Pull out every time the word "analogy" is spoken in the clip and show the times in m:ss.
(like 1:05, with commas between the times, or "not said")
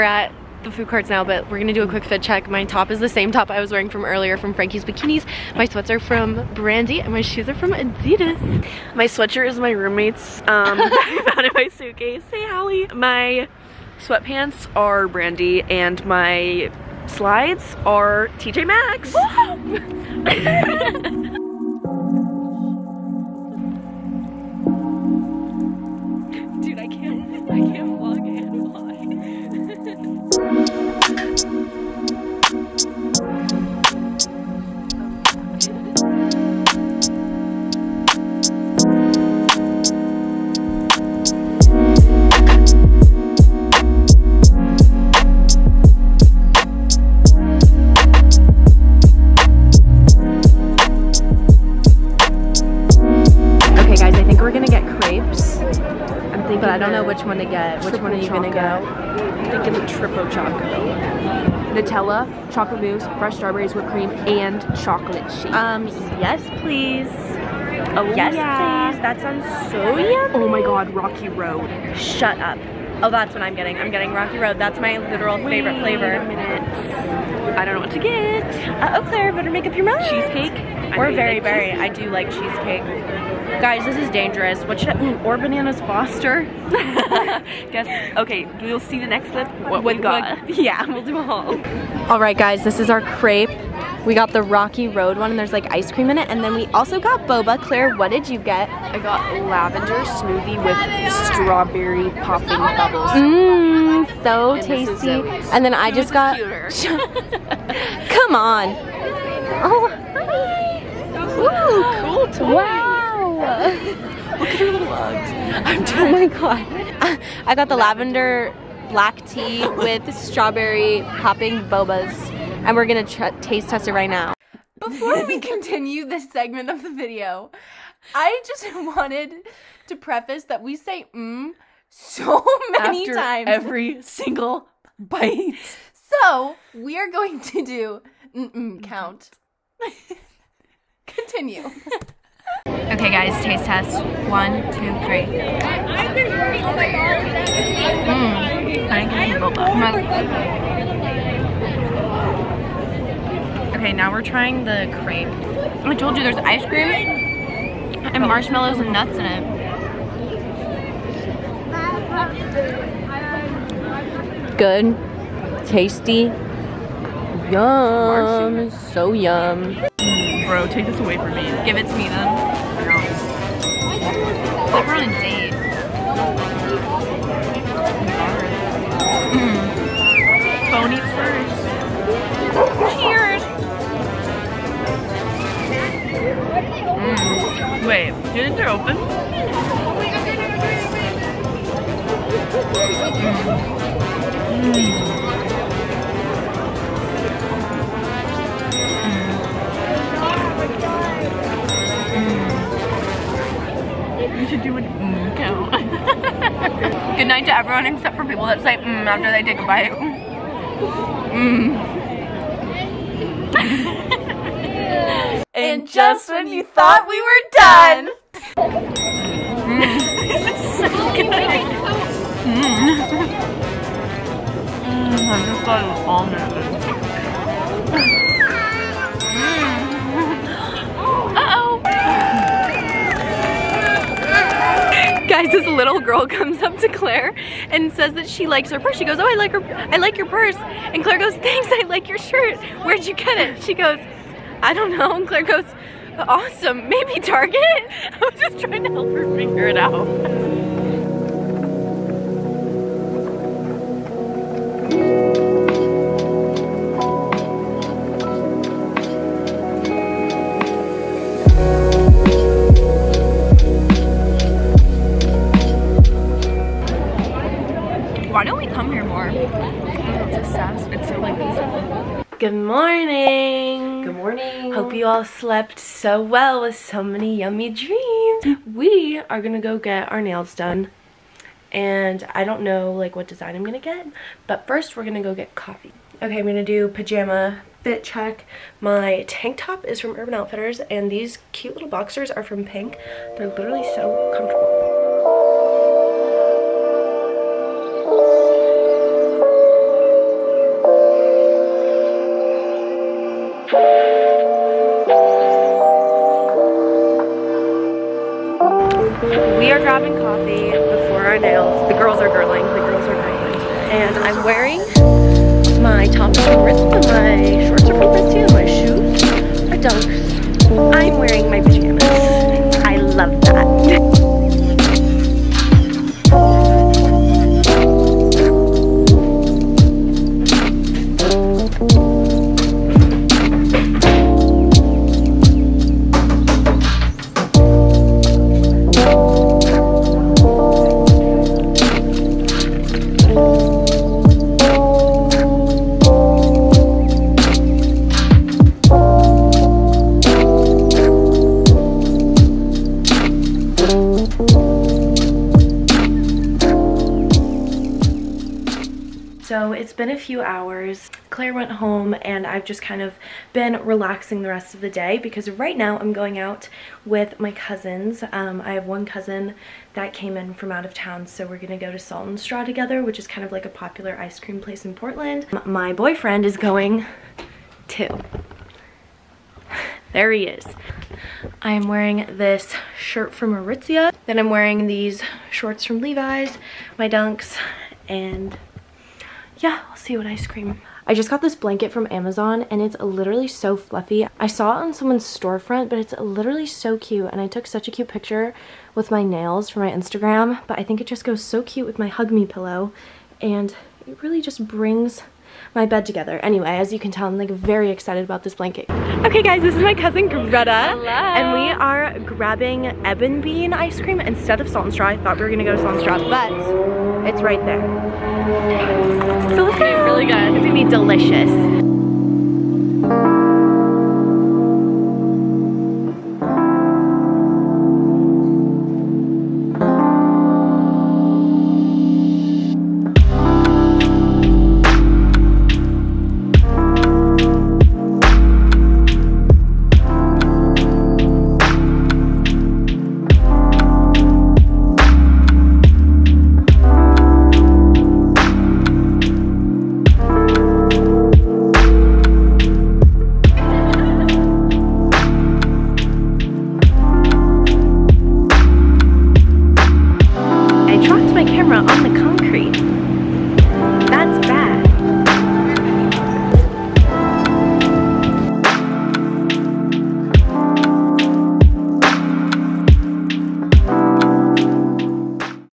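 not said.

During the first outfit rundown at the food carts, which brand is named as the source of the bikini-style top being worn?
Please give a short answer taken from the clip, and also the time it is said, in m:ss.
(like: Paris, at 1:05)
Frankie's Bikinis, at 0:04.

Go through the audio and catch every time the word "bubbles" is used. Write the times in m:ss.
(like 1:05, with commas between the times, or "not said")
1:42.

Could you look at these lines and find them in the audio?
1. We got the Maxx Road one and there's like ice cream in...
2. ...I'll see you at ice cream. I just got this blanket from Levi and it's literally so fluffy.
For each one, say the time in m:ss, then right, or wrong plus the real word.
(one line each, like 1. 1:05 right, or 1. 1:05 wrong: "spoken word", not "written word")
1. 1:34 wrong: "Rocky", not "Maxx"
2. 6:29 wrong: "Amazon", not "Levi".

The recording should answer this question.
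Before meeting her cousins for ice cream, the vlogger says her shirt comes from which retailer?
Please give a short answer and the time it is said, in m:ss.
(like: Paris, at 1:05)
Aritzia, at 6:23.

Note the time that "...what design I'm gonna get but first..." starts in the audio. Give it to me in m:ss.
4:43.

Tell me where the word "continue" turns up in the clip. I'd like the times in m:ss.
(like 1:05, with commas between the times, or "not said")
2:05, 2:21.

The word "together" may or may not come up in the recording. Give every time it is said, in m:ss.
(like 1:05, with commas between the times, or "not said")
6:12, 6:46.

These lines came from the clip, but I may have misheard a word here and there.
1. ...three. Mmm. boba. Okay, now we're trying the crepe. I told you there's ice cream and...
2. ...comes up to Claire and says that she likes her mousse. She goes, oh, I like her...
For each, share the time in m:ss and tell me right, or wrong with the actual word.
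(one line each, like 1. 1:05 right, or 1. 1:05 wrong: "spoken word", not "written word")
1. 2:25 right
2. 3:56 wrong: "purse", not "mousse".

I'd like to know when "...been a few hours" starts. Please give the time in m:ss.
5:59.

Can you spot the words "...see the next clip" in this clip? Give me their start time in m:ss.
1:28.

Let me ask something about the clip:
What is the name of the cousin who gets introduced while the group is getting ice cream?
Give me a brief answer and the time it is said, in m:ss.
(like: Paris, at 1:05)
Greta, at 6:50.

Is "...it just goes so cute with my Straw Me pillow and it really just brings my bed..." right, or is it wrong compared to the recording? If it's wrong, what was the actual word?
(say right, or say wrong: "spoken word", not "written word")
wrong: "Hug", not "Straw".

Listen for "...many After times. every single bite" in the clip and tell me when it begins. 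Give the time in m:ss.
2:12.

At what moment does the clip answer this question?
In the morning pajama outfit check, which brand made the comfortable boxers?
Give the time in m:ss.
4:52.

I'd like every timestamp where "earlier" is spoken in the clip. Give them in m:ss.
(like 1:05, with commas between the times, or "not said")
0:04.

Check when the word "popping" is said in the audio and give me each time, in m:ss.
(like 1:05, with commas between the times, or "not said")
1:42, 2:01.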